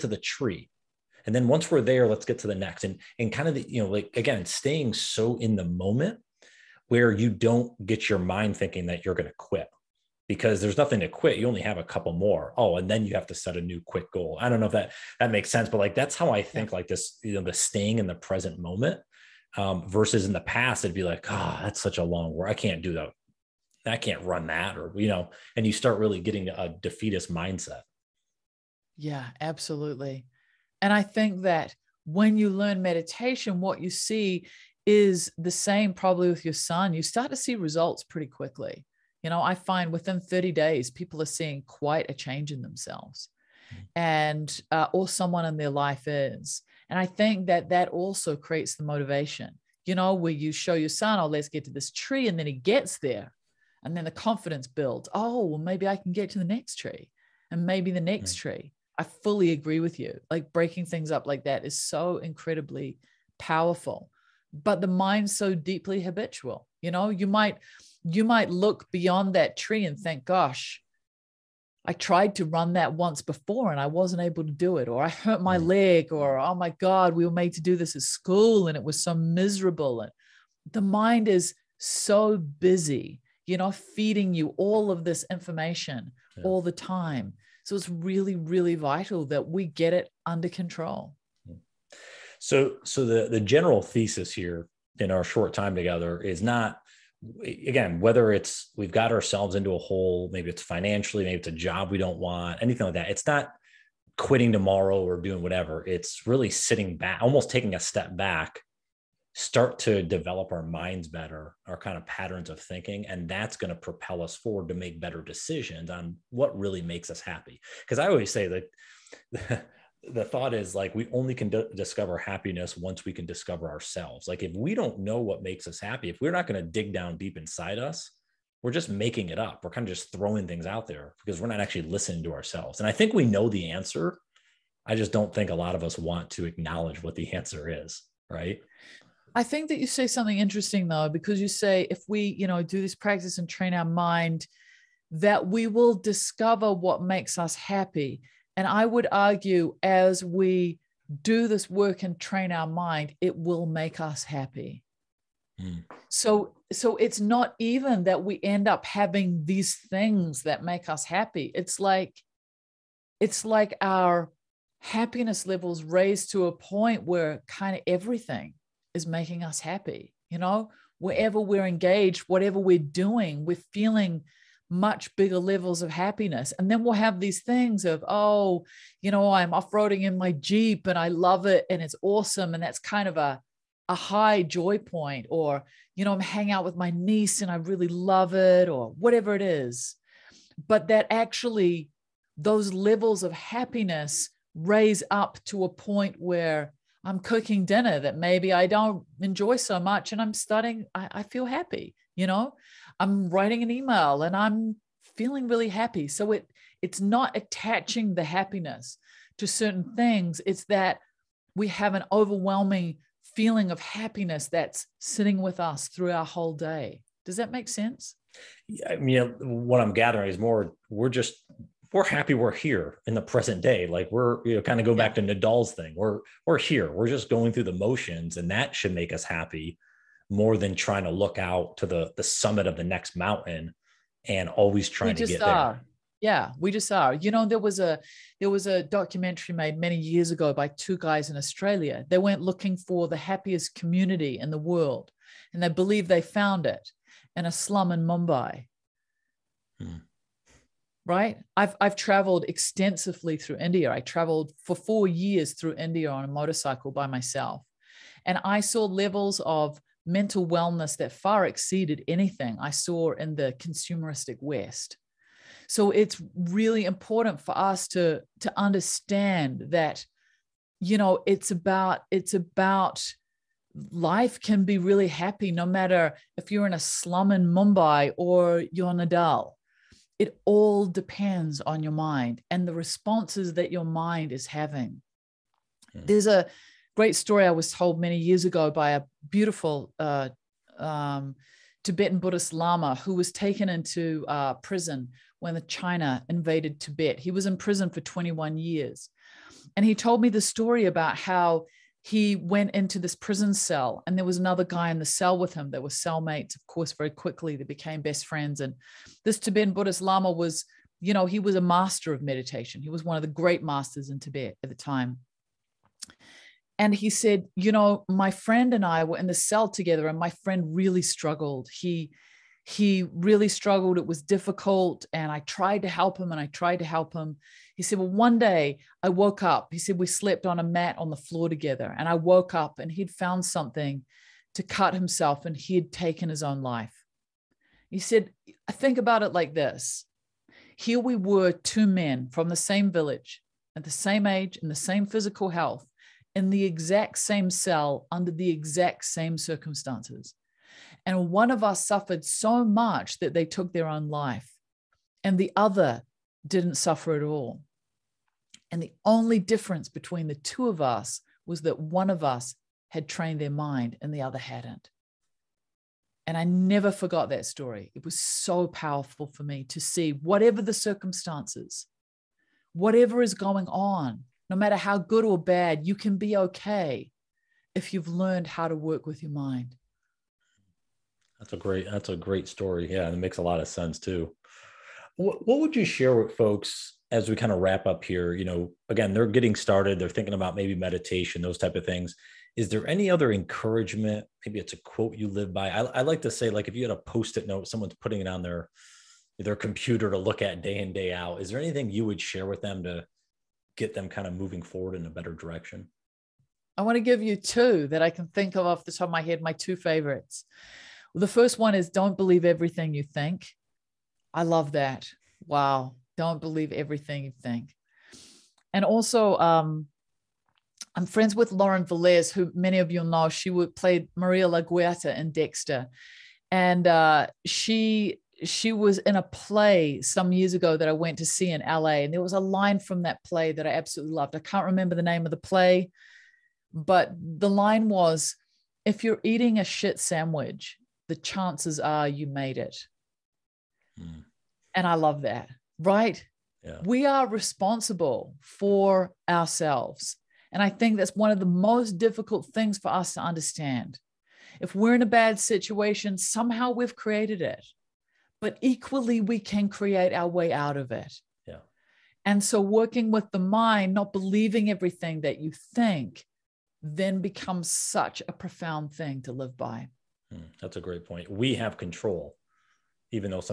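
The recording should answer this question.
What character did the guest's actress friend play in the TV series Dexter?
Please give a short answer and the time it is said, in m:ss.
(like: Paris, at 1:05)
Maria LaGuerta, at 7:04.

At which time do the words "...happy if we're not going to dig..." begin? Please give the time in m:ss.
2:05.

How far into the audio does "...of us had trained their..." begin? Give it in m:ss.
6:02.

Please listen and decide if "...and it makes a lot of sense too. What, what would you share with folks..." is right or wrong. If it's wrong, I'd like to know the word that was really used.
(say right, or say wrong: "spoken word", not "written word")
right.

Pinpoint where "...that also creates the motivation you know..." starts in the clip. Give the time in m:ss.
0:47.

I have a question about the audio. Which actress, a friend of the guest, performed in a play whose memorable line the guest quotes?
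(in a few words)
Lauren Velez.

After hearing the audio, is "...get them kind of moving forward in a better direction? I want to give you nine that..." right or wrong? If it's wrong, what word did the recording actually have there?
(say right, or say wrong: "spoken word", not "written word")
wrong: "two", not "nine".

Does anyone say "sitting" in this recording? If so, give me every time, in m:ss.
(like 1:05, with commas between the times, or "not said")
1:46, 3:34.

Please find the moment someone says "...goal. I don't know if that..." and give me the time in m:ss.
0:14.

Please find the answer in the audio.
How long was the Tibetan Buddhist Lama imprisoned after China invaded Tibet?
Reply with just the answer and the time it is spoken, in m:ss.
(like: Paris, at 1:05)
21 years, at 4:57.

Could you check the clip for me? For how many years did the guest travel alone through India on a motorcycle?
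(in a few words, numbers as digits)
4 years.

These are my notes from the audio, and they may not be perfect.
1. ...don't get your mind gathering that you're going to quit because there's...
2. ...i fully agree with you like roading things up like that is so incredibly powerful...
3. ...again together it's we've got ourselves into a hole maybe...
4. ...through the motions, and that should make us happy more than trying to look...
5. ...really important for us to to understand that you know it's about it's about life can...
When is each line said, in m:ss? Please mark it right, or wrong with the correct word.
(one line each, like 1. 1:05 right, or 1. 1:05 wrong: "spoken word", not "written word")
1. 0:07 wrong: "thinking", not "gathering"
2. 0:58 wrong: "breaking", not "roading"
3. 1:37 wrong: "whether", not "together"
4. 3:47 right
5. 4:26 right.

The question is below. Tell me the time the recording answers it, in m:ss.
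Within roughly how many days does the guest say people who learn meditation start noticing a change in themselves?
0:40.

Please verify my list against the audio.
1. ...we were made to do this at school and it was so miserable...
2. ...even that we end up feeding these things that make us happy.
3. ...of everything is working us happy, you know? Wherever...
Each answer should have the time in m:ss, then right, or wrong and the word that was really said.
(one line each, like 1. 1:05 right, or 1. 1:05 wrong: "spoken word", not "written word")
1. 1:17 right
2. 2:37 wrong: "having", not "feeding"
3. 2:47 wrong: "making", not "working".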